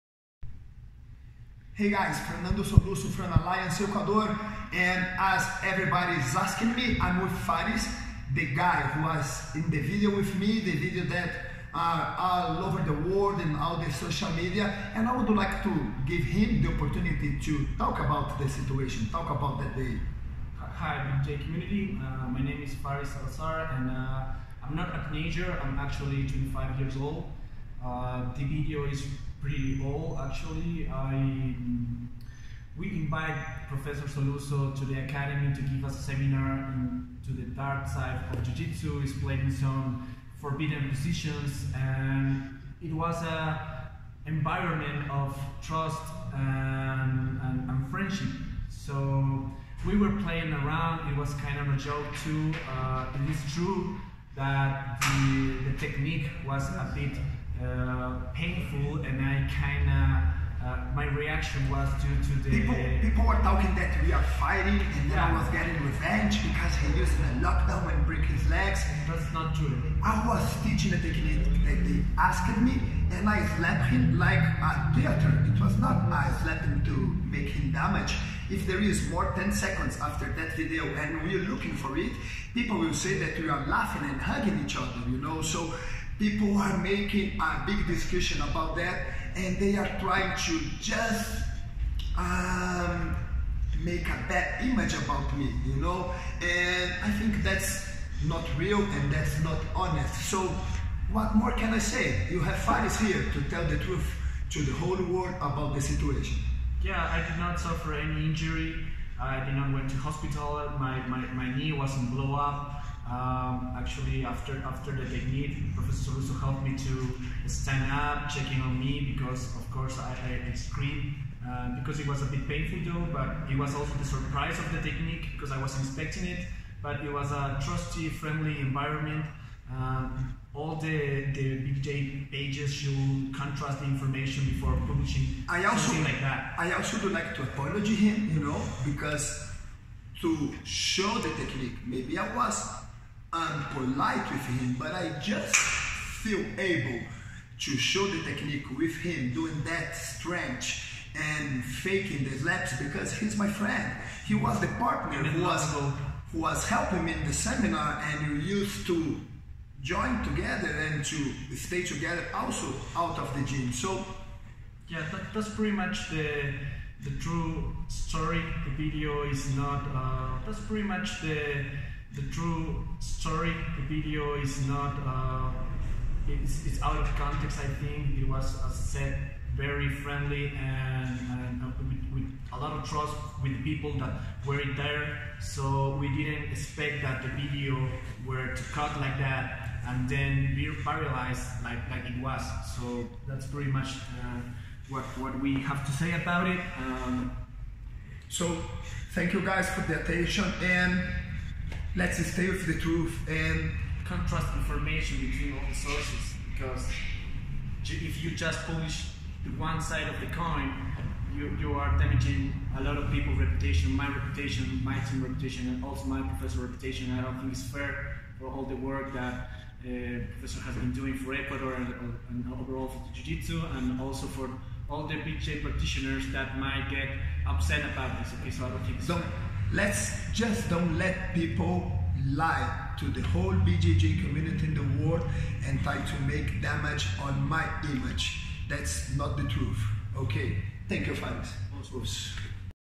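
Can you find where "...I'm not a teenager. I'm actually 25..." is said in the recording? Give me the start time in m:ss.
0:24.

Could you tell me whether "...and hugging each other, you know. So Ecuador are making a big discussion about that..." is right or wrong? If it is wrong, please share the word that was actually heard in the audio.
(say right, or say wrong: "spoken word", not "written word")
wrong: "People", not "Ecuador".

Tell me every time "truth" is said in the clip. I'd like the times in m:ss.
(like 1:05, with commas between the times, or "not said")
1:43, 3:22, 3:59.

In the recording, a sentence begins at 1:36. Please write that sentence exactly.
And I think that's not real and that's not honest.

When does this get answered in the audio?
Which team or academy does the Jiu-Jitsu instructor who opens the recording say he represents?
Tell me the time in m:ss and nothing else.
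0:03.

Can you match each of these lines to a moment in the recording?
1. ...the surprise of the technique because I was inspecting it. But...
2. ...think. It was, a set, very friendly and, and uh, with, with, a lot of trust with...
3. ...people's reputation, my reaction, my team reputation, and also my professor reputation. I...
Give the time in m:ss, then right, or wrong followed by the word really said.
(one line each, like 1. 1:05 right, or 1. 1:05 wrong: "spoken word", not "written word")
1. 2:03 right
2. 2:57 right
3. 3:33 wrong: "reputation", not "reaction".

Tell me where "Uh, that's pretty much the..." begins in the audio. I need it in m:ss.
2:49.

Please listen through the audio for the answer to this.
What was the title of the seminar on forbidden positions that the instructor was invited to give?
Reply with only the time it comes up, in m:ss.
0:37.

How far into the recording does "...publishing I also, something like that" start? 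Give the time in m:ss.
2:14.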